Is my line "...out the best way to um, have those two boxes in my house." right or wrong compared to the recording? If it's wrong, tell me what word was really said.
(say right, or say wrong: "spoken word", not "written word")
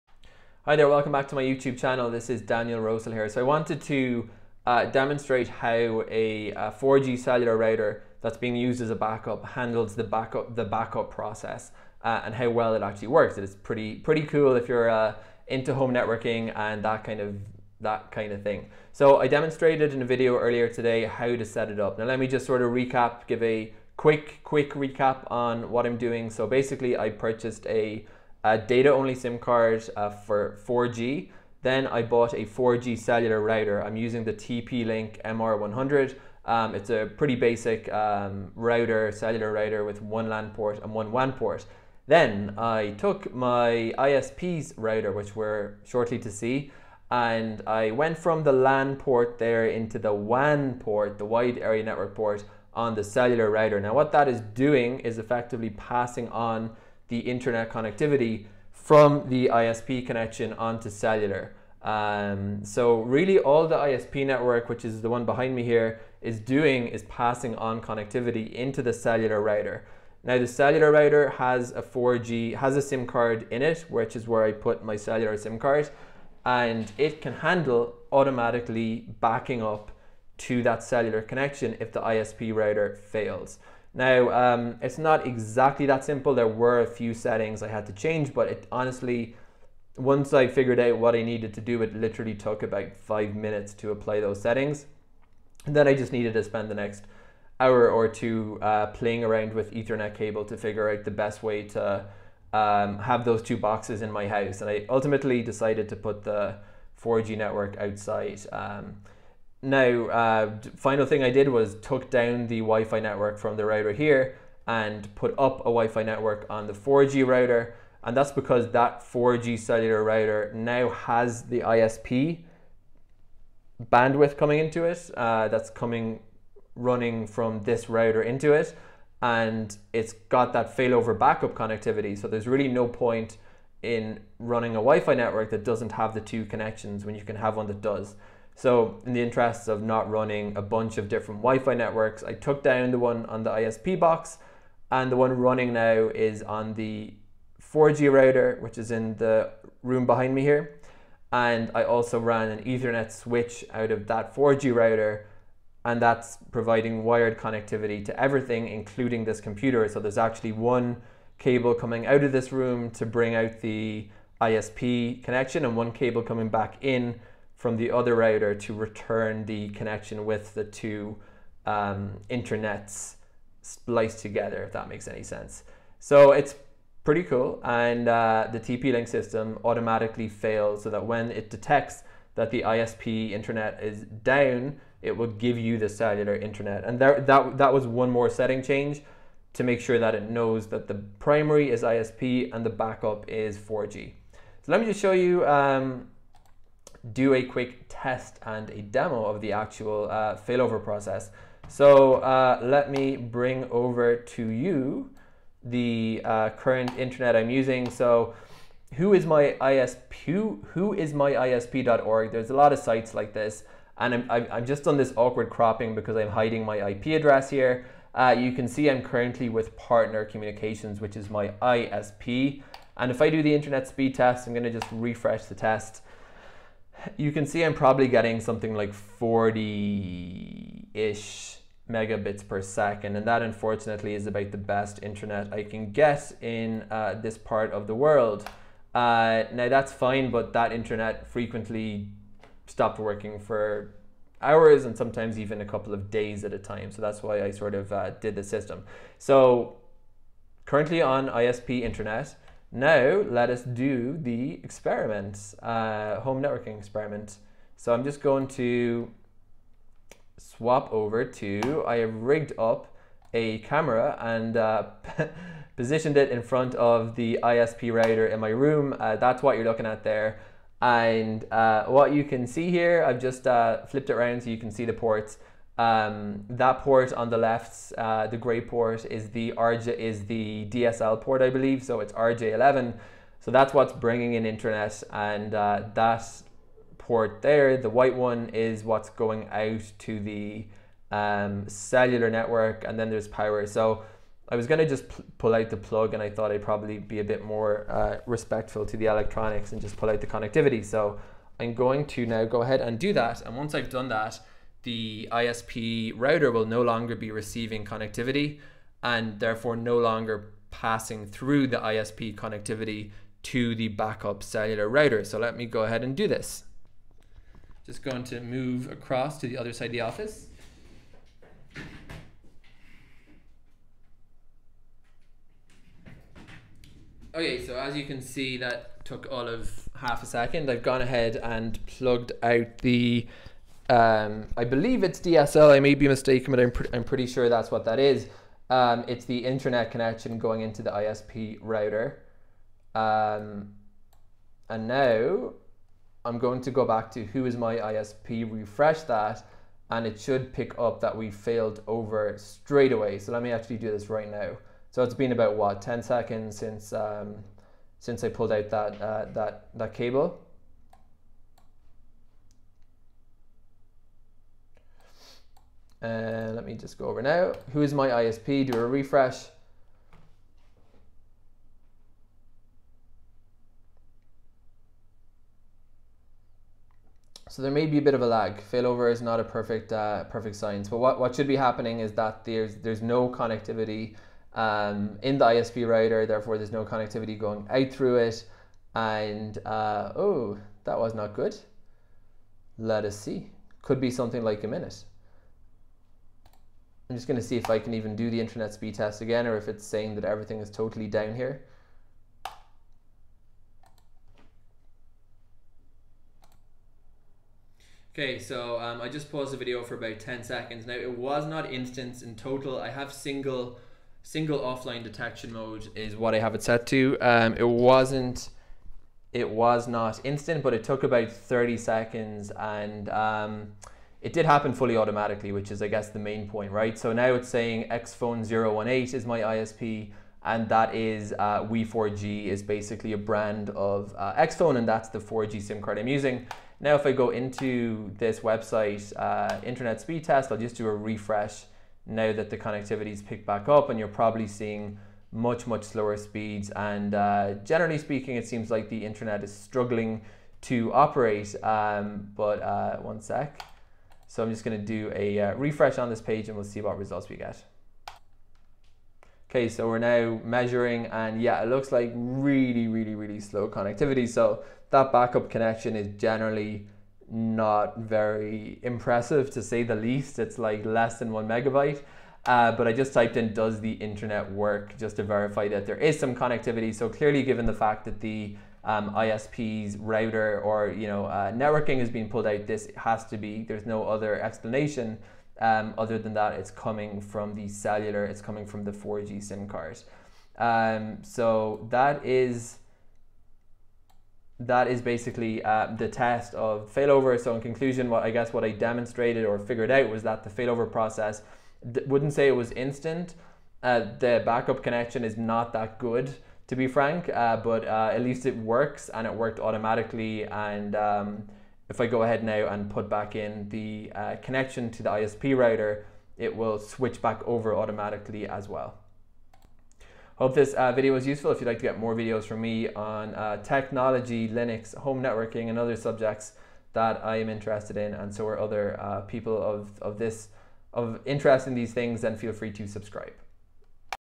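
right.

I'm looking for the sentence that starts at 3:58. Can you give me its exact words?
Uh, now that's fine, but that internet frequently stopped working for hours and sometimes even a couple of days at a time.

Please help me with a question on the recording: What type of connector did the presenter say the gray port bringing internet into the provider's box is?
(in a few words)
RJ11.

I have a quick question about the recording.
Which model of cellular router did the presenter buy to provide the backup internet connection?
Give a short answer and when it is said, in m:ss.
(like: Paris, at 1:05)
TP-Link MR100, at 0:34.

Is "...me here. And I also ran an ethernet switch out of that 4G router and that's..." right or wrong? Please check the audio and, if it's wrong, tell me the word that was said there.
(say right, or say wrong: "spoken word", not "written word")
right.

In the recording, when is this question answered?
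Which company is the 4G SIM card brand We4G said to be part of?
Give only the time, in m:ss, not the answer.
7:14.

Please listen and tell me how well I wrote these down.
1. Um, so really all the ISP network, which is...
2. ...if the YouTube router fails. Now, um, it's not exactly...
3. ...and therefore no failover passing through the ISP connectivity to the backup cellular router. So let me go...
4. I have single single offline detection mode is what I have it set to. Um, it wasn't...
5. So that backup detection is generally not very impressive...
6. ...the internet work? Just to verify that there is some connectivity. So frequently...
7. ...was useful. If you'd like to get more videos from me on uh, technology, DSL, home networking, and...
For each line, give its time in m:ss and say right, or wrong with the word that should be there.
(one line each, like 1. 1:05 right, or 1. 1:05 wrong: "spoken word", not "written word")
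1. 1:01 right
2. 1:21 wrong: "ISP", not "YouTube"
3. 5:09 wrong: "longer", not "failover"
4. 6:52 right
5. 7:44 wrong: "connection", not "detection"
6. 7:53 wrong: "clearly", not "frequently"
7. 8:41 wrong: "Linux", not "DSL".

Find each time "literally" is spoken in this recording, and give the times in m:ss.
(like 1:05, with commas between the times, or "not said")
1:31.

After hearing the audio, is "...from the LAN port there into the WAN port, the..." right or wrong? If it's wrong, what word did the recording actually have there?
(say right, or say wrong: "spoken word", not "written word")
right.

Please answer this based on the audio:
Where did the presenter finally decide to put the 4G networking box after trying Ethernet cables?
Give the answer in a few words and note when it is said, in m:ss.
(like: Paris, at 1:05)
Outside, at 1:47.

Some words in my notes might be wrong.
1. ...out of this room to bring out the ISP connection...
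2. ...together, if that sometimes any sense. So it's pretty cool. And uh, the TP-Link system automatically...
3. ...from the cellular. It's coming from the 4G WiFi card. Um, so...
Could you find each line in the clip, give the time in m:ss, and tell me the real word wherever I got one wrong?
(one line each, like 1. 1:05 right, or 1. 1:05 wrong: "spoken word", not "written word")
1. 2:42 right
2. 2:54 wrong: "makes", not "sometimes"
3. 8:07 wrong: "SIM", not "WiFi".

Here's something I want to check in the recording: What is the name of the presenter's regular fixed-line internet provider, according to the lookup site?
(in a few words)
Partner Communications.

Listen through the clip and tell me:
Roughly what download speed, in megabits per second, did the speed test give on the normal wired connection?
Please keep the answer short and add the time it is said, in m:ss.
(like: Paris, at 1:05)
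40, at 3:49.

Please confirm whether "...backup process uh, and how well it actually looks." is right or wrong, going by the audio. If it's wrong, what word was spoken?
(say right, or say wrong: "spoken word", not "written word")
wrong: "works", not "looks".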